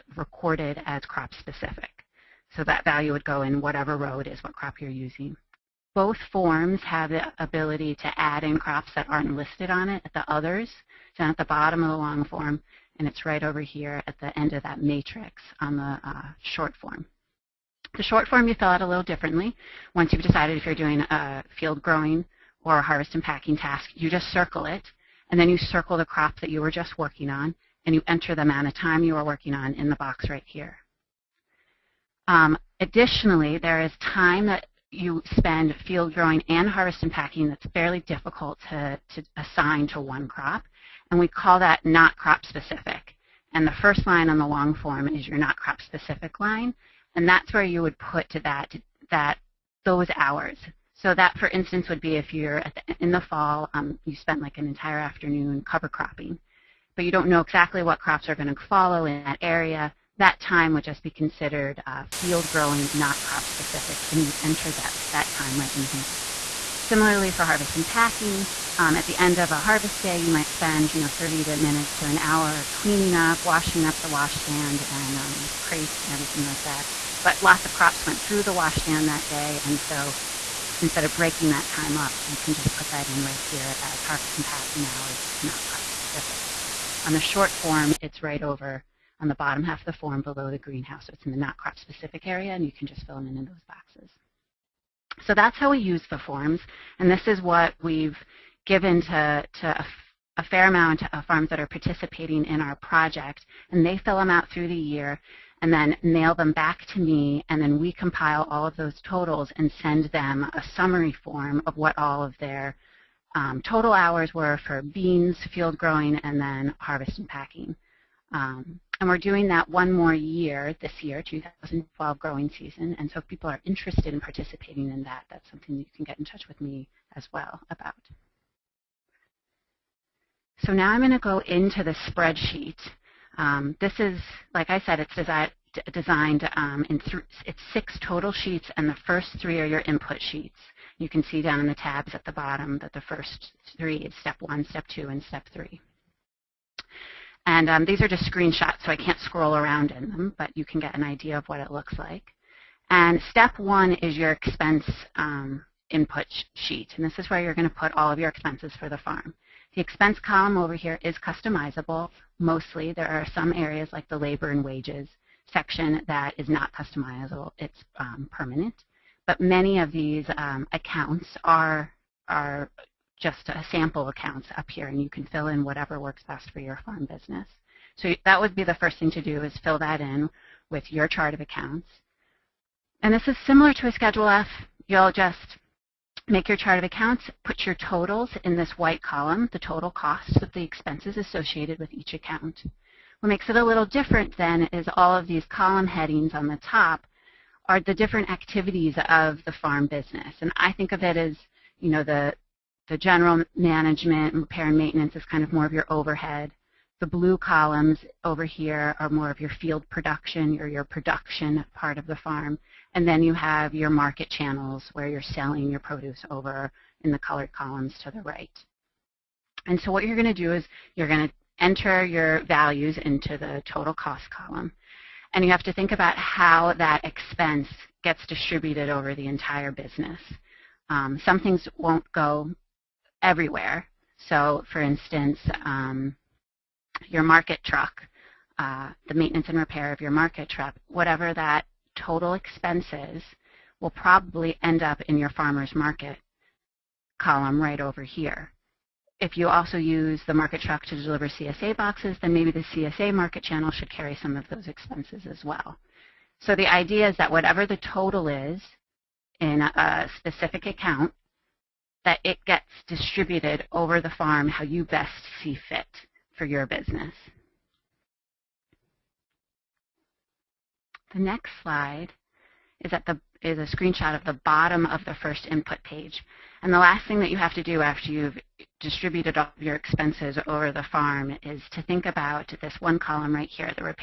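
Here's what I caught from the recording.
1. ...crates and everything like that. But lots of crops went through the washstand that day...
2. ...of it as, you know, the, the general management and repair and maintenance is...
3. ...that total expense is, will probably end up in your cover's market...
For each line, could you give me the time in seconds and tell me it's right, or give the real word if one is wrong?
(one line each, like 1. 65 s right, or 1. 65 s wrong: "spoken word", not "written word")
1. 75 s right
2. 200 s right
3. 241 s wrong: "farmer", not "cover".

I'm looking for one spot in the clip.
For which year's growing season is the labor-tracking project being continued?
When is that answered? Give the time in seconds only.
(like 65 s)
121 s.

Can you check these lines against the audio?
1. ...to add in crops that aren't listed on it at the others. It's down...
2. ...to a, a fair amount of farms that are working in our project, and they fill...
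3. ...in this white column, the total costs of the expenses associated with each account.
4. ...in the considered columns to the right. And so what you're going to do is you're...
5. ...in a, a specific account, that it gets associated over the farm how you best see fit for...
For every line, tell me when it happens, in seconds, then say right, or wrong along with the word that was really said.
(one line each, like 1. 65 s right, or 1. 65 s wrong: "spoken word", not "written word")
1. 7 s right
2. 99 s wrong: "participating", not "working"
3. 188 s right
4. 217 s wrong: "colored", not "considered"
5. 259 s wrong: "distributed", not "associated".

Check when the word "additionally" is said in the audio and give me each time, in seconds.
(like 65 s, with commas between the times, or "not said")
32 s.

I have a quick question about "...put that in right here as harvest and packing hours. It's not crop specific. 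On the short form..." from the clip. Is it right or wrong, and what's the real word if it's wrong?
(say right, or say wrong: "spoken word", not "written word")
right.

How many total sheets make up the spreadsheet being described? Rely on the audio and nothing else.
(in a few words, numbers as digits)
6.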